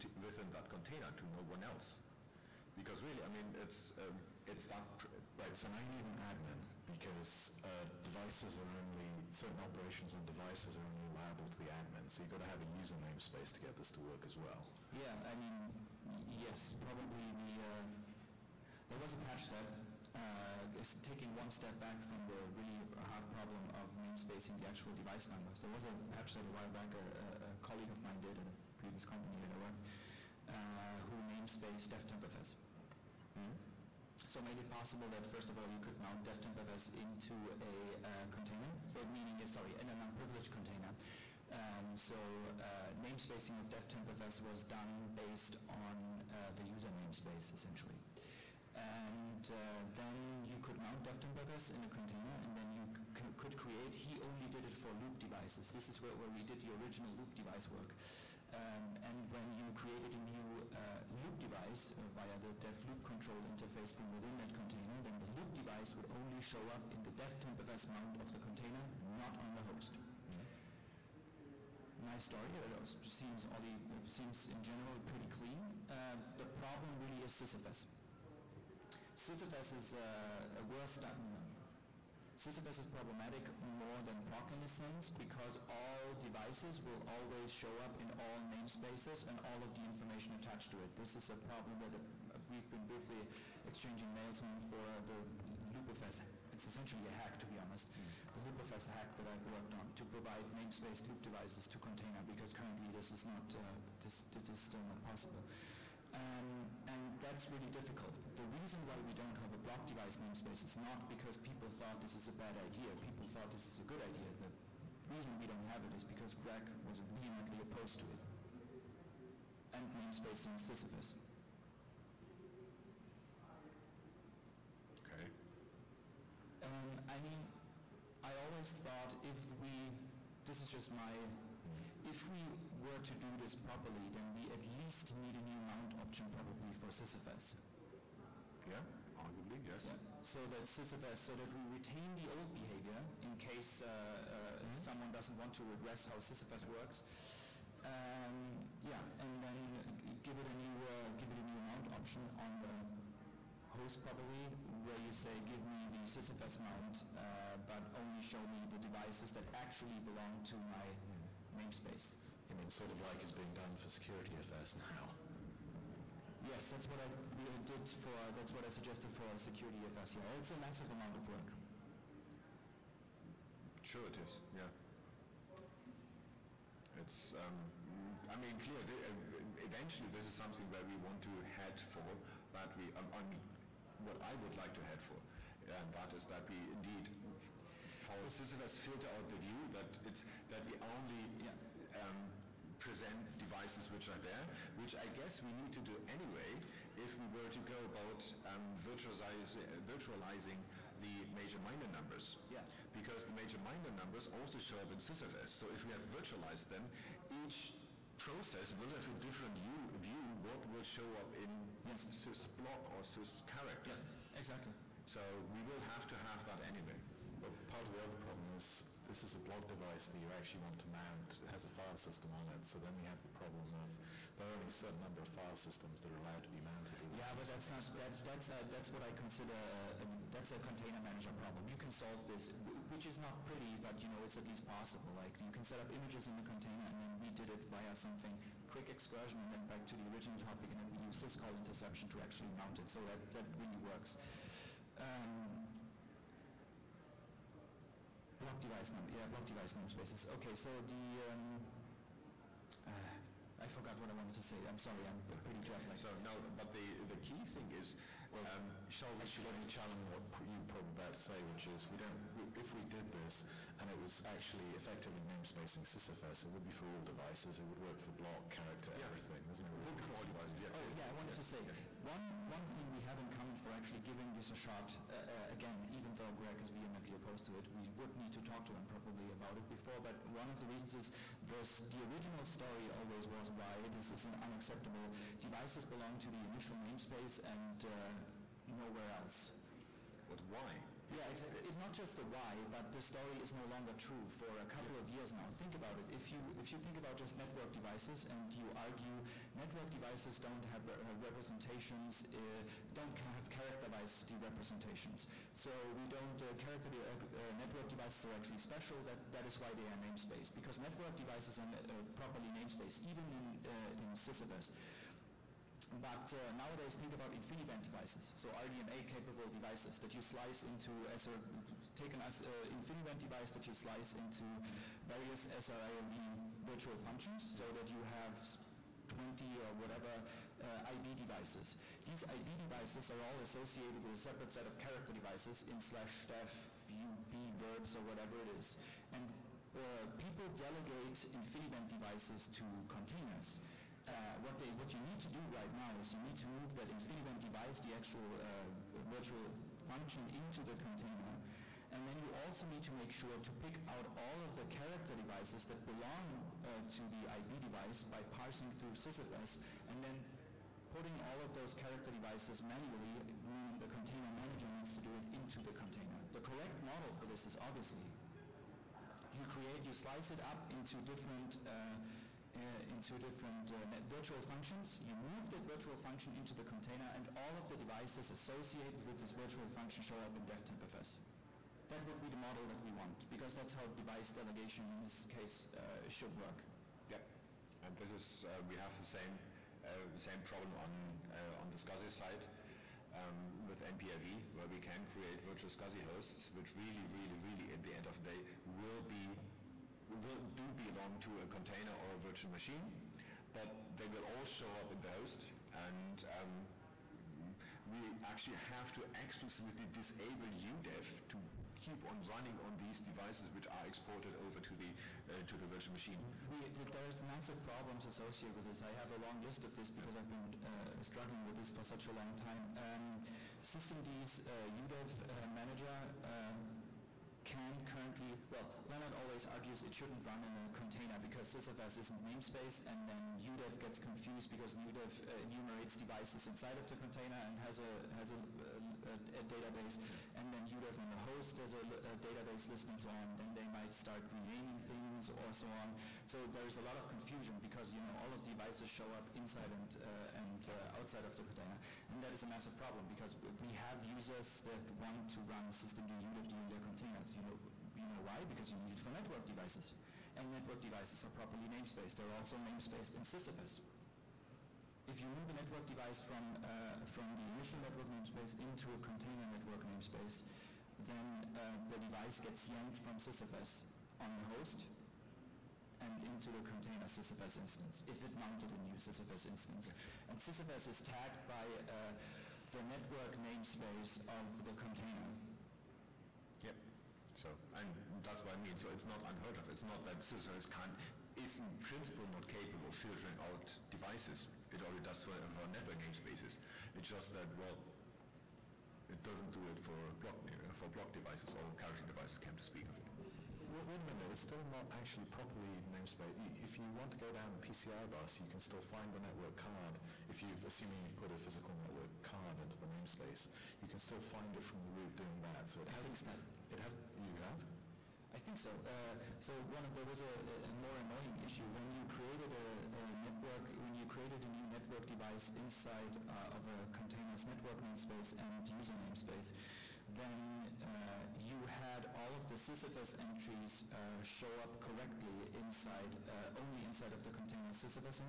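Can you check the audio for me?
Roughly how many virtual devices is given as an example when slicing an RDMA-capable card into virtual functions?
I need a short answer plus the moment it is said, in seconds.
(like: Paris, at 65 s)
20, at 329 s.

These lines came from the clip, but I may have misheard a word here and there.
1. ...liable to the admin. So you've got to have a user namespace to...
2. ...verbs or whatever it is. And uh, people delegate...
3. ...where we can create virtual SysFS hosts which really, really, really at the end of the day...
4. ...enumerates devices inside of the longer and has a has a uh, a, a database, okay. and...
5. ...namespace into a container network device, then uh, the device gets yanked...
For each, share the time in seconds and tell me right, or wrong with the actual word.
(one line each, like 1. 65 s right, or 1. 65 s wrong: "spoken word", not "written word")
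1. 11 s right
2. 337 s right
3. 394 s wrong: "SCSI", not "SysFS"
4. 435 s wrong: "container", not "longer"
5. 468 s wrong: "namespace", not "device".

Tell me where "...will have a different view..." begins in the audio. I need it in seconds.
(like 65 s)
208 s.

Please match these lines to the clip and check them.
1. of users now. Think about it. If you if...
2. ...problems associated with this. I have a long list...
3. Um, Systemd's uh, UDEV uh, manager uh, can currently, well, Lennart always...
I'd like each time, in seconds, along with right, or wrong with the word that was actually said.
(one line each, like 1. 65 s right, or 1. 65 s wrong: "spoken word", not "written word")
1. 295 s wrong: "years", not "users"
2. 417 s right
3. 422 s right.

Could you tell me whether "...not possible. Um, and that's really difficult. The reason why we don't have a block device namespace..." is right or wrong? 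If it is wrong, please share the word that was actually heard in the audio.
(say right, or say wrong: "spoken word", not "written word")
right.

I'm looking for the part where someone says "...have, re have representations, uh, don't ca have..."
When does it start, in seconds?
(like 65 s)
300 s.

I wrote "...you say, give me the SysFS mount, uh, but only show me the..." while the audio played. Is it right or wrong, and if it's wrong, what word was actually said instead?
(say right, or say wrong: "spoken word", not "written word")
right.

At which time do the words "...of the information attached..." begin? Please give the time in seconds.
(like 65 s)
89 s.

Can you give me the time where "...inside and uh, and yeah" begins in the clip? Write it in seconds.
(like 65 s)
449 s.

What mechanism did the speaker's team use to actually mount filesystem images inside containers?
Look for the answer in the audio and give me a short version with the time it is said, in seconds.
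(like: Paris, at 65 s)
syscall interception, at 241 s.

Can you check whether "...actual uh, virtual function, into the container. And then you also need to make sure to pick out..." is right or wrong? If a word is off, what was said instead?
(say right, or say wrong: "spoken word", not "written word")
right.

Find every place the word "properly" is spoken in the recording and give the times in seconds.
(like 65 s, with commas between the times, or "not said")
133 s, 312 s, 461 s, 505 s.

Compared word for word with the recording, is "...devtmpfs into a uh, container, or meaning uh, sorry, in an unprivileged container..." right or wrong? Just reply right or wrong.
right.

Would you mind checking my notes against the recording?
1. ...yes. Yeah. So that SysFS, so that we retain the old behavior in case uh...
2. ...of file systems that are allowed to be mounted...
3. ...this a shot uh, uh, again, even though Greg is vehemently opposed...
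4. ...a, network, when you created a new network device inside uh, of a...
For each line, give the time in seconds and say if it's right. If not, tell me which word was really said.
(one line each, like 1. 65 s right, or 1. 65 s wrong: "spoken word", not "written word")
1. 139 s right
2. 225 s right
3. 274 s right
4. 523 s right.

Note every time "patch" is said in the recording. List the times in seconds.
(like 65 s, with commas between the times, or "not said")
19 s, 26 s.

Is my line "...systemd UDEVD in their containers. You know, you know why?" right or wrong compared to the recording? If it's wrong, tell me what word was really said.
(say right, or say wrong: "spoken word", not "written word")
right.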